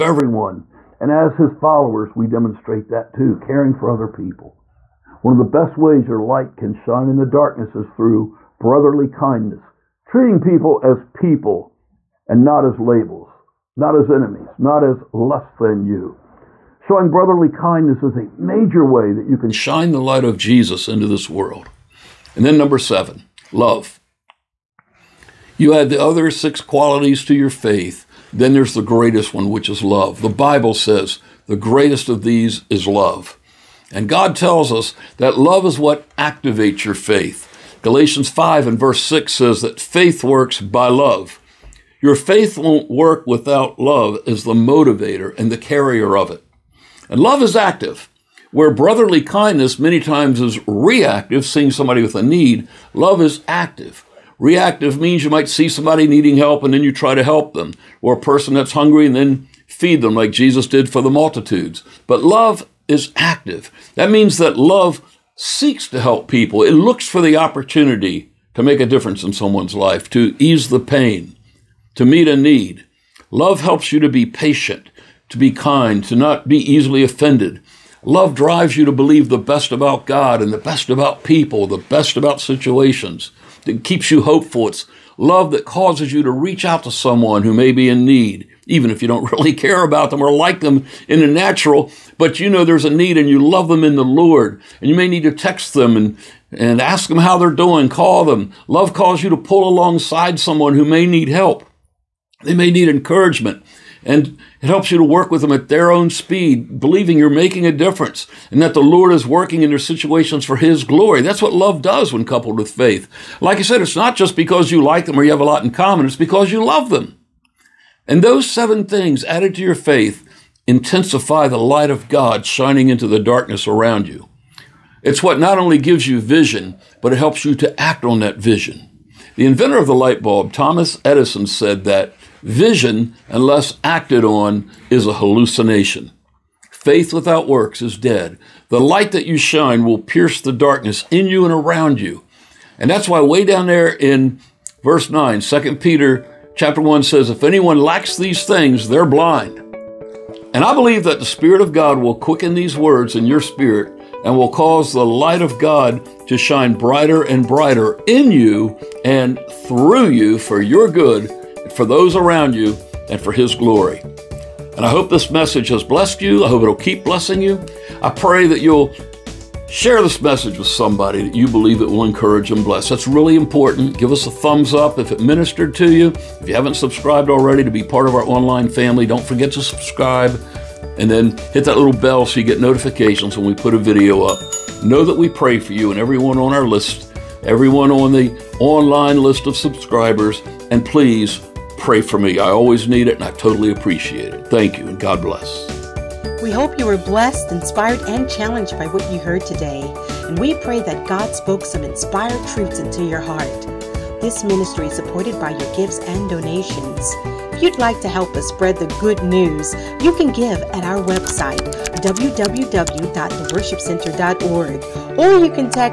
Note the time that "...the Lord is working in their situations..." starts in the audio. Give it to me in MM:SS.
01:48.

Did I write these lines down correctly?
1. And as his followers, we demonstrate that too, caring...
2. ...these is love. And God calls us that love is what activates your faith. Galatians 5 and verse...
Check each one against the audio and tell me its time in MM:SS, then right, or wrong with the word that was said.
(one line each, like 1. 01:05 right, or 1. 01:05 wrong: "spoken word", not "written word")
1. 00:00 right
2. 00:32 wrong: "tells", not "calls".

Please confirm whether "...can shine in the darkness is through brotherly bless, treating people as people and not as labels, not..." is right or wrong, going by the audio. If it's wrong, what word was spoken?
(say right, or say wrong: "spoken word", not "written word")
wrong: "kindness", not "bless".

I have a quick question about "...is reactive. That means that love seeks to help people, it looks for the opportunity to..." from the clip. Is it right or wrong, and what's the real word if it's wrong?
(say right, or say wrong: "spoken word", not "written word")
wrong: "active", not "reactive".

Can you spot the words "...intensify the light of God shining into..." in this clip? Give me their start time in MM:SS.
02:00.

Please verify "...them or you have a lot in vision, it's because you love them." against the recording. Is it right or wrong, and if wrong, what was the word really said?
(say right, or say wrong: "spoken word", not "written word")
wrong: "common", not "vision".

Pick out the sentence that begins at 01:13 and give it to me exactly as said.
Love helps you to be patient, to be kind, to not be easily offended.